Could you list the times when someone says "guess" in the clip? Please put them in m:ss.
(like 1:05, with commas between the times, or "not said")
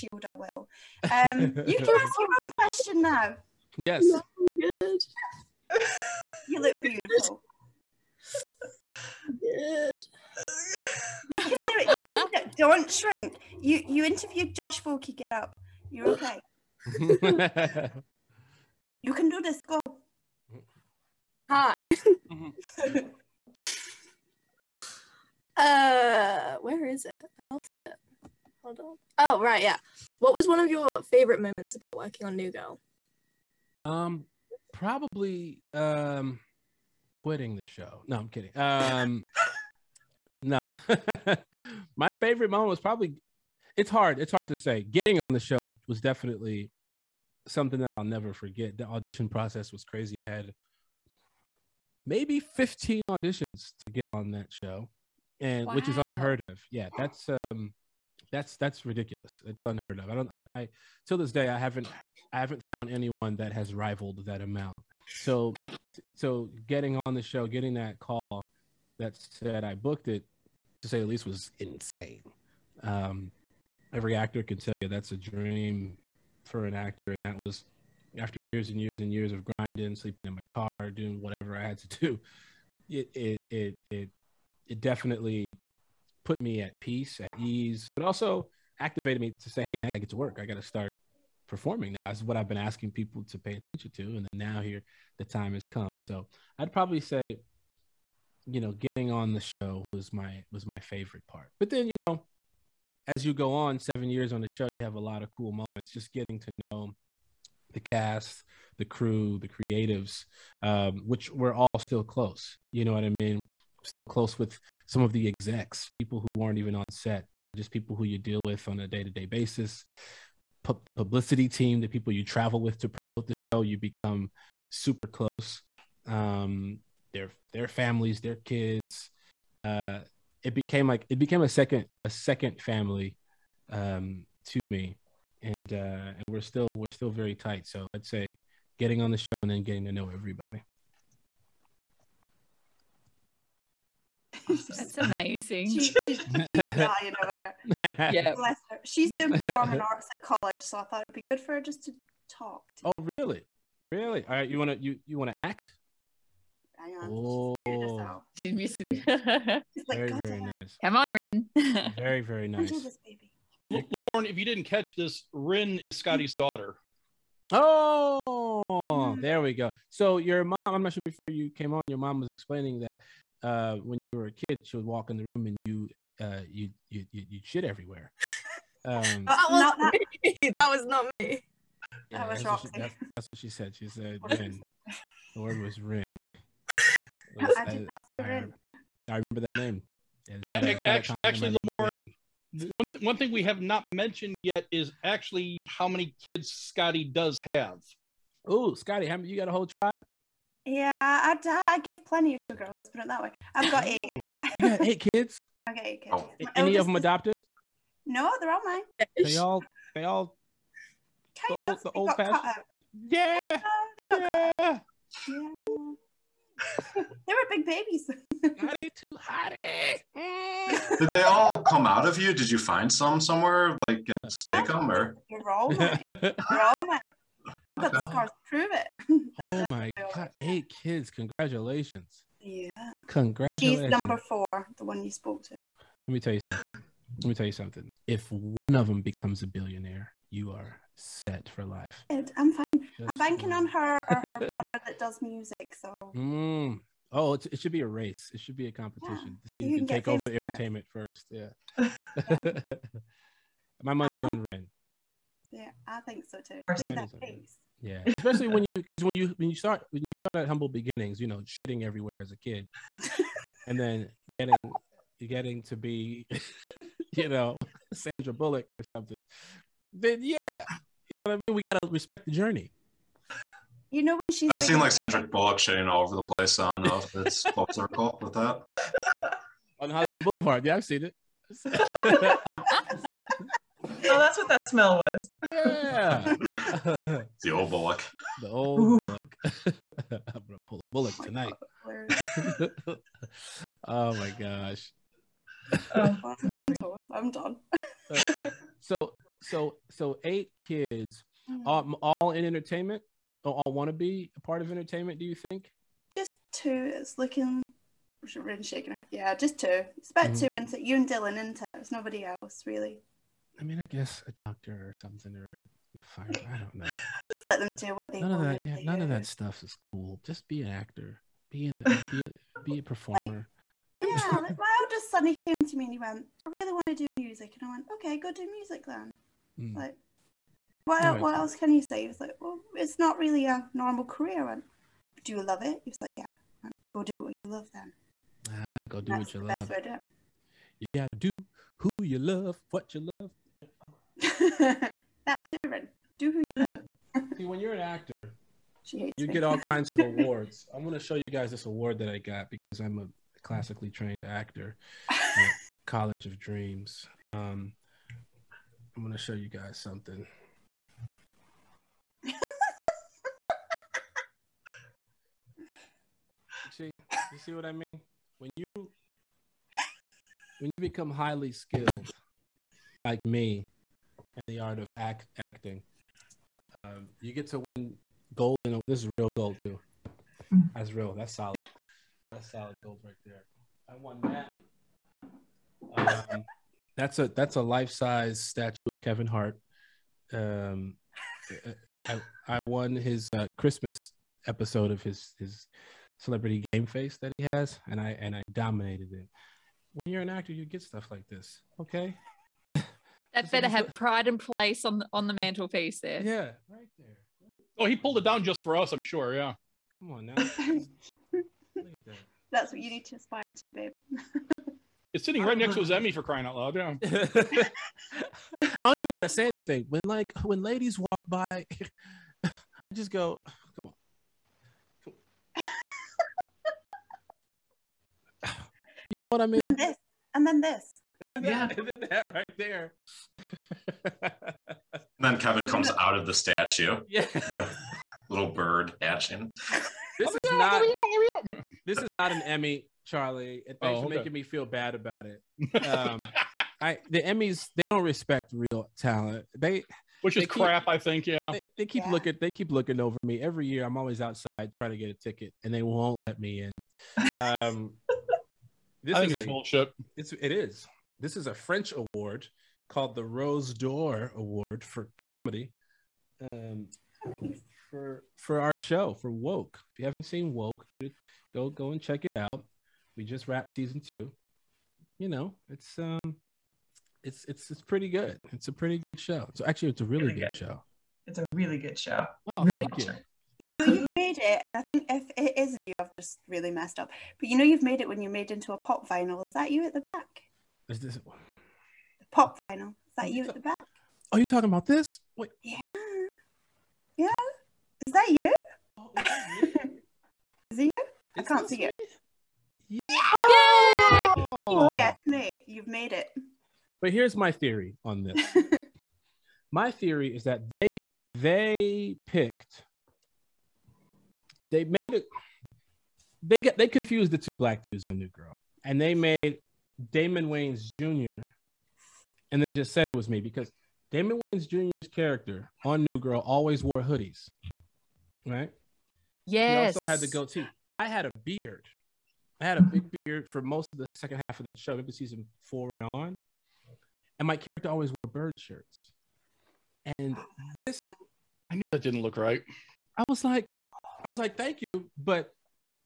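5:13.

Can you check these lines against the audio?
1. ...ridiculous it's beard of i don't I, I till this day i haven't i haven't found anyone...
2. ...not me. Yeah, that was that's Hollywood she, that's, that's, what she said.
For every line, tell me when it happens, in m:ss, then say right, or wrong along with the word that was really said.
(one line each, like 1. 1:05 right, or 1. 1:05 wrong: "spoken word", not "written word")
1. 0:58 wrong: "unheard", not "beard"
2. 3:00 wrong: "What", not "Hollywood".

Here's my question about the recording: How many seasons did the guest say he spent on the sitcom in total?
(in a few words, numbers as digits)
7.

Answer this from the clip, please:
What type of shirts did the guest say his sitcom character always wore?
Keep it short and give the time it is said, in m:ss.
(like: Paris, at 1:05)
Bird shirts, at 8:58.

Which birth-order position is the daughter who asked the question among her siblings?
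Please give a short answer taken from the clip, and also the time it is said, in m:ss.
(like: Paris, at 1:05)
Number four, at 3:53.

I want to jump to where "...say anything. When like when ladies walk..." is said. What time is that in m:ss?
6:59.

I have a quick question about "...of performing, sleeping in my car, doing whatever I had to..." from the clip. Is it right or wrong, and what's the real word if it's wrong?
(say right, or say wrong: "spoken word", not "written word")
wrong: "grinding", not "performing".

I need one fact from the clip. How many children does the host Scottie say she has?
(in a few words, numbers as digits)
8.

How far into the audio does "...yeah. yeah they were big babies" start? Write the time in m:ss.
3:34.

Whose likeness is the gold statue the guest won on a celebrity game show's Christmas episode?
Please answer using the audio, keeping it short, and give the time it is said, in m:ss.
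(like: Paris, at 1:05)
Kevin Hart, at 6:29.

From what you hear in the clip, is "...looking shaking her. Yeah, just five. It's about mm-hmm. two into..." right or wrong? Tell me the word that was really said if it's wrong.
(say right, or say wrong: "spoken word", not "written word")
wrong: "two", not "five".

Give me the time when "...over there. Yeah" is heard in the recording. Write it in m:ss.
2:27.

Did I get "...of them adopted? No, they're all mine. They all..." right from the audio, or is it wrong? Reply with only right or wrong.
right.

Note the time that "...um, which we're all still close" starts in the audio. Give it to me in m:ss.
1:50.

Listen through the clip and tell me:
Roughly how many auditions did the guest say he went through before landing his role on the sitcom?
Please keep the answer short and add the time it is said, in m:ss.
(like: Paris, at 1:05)
15, at 0:52.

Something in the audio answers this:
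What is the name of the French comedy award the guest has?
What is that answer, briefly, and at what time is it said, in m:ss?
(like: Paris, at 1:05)
Rose d'Or, at 7:43.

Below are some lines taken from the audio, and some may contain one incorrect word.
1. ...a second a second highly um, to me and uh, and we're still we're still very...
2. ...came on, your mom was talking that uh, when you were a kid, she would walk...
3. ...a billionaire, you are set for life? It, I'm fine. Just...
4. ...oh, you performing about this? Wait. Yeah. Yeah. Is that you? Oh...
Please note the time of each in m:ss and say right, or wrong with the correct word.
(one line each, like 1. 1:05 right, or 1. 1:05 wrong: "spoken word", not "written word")
1. 2:11 wrong: "family", not "highly"
2. 2:51 wrong: "explaining", not "talking"
3. 3:59 right
4. 8:14 wrong: "talking", not "performing".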